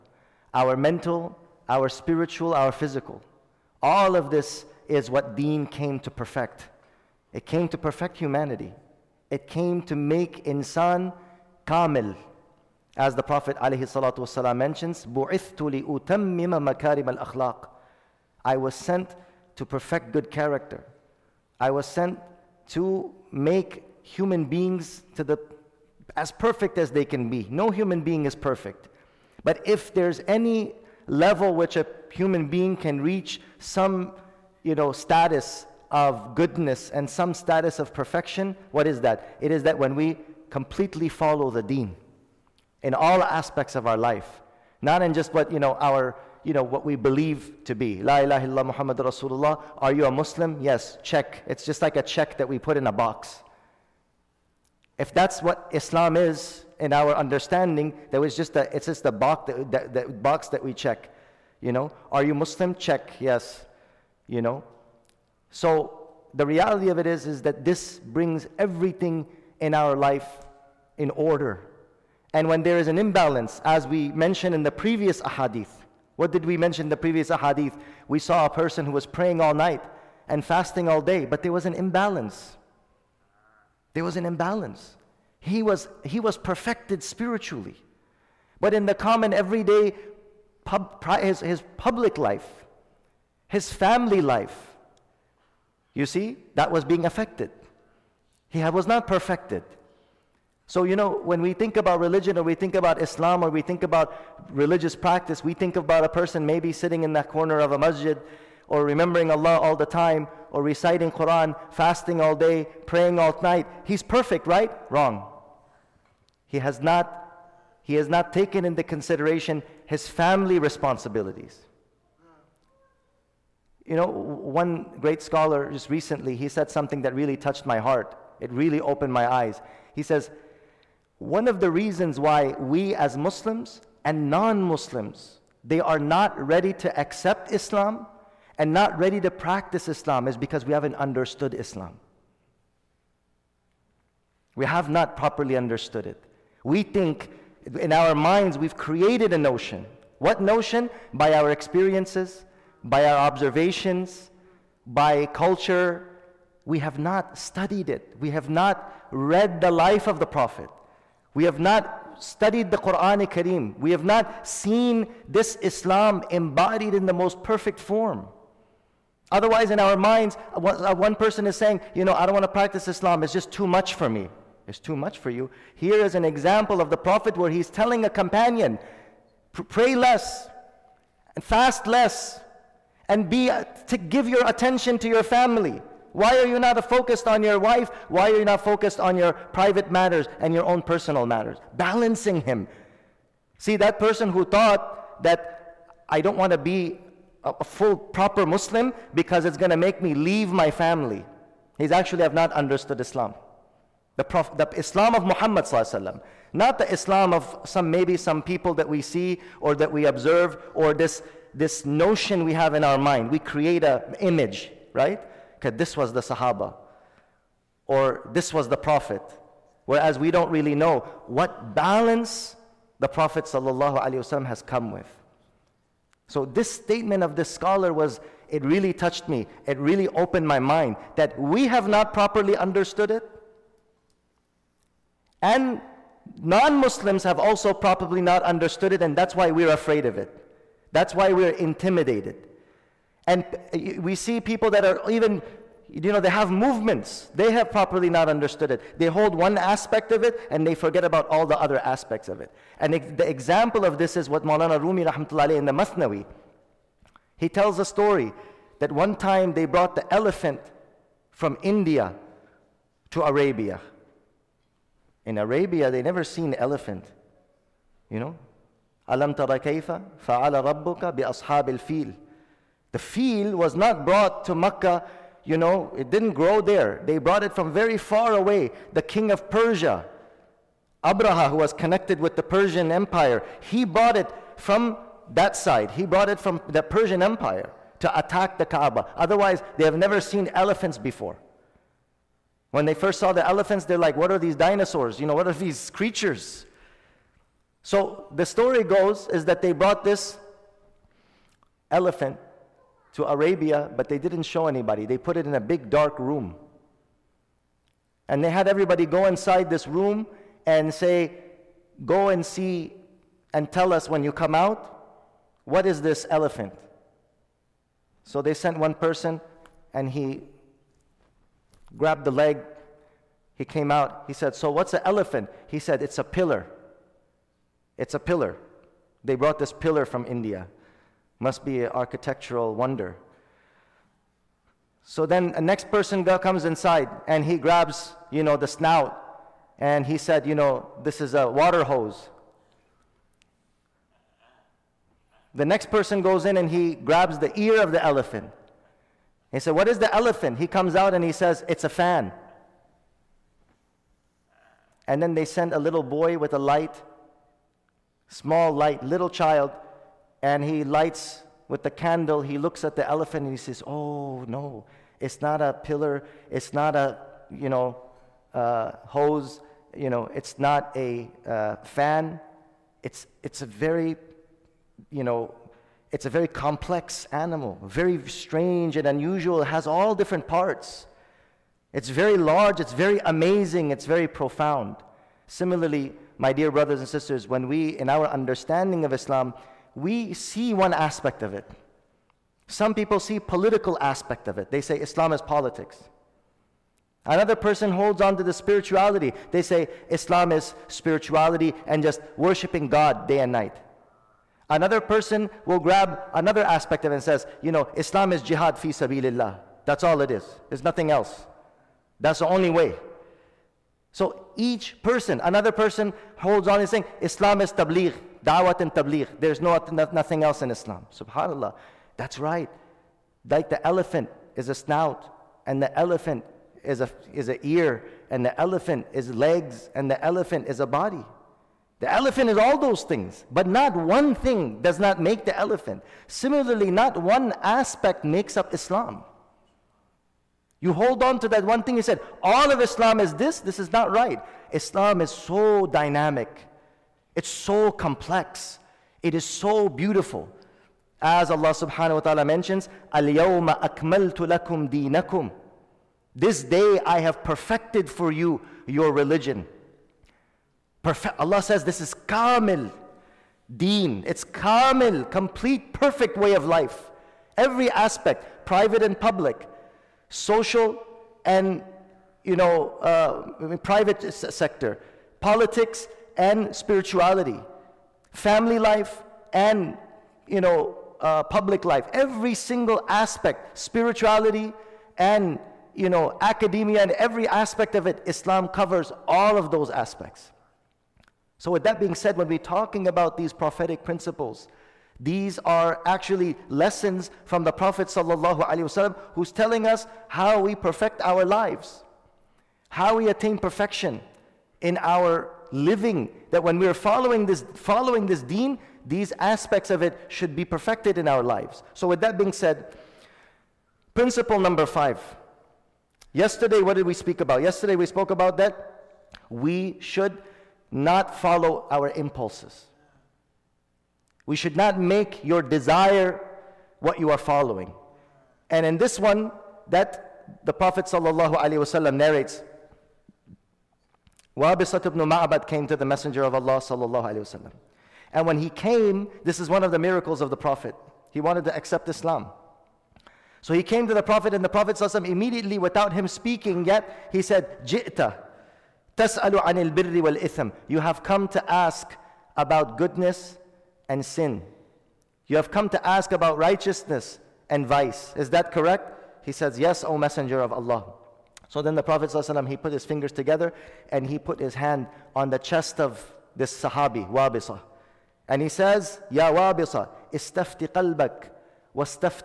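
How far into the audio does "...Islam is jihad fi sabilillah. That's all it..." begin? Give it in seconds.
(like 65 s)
407 s.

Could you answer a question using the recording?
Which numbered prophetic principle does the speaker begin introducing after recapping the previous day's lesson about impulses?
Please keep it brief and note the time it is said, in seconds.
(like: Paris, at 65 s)
5, at 514 s.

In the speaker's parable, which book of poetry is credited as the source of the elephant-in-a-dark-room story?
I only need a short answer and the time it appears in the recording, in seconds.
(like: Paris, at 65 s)
Masnawi, at 255 s.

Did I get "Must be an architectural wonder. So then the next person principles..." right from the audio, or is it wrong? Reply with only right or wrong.
wrong.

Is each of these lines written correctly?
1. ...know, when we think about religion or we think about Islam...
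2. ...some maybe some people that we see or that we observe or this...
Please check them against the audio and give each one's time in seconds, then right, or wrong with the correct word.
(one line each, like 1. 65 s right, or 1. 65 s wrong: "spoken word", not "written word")
1. 100 s right
2. 207 s right.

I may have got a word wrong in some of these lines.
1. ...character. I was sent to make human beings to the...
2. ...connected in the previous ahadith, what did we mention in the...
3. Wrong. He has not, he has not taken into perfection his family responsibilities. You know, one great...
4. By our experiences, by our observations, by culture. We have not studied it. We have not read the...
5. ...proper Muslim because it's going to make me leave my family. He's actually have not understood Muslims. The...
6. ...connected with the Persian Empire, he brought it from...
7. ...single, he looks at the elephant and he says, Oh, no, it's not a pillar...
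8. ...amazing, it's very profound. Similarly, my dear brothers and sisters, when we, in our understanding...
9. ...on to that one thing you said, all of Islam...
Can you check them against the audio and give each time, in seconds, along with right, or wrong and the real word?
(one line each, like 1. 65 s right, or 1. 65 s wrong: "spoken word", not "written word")
1. 20 s right
2. 74 s wrong: "mentioned", not "connected"
3. 114 s wrong: "consideration", not "perfection"
4. 151 s right
5. 197 s wrong: "Islam", not "Muslims"
6. 281 s right
7. 361 s wrong: "candle", not "single"
8. 383 s right
9. 441 s right.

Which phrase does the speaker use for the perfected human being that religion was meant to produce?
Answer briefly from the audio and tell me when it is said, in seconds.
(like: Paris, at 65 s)
Insan kamil, at 10 s.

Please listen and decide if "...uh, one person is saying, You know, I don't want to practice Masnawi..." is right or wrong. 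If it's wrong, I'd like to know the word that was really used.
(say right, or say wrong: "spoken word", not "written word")
wrong: "Islam", not "Masnawi".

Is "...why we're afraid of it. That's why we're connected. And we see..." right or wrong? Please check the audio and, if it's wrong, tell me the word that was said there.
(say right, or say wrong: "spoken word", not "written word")
wrong: "intimidated", not "connected".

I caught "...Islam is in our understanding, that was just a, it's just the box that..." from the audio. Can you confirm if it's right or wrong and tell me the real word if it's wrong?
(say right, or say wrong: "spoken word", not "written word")
right.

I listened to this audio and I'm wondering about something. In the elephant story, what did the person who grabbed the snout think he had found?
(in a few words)
A water hose.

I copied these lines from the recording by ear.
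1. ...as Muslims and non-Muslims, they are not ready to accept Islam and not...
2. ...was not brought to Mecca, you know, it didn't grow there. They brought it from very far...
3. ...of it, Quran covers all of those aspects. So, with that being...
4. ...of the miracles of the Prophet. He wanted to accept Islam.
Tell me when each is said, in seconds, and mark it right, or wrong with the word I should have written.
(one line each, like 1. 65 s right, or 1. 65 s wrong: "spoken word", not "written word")
1. 132 s right
2. 273 s right
3. 487 s wrong: "Islam", not "Quran"
4. 539 s right.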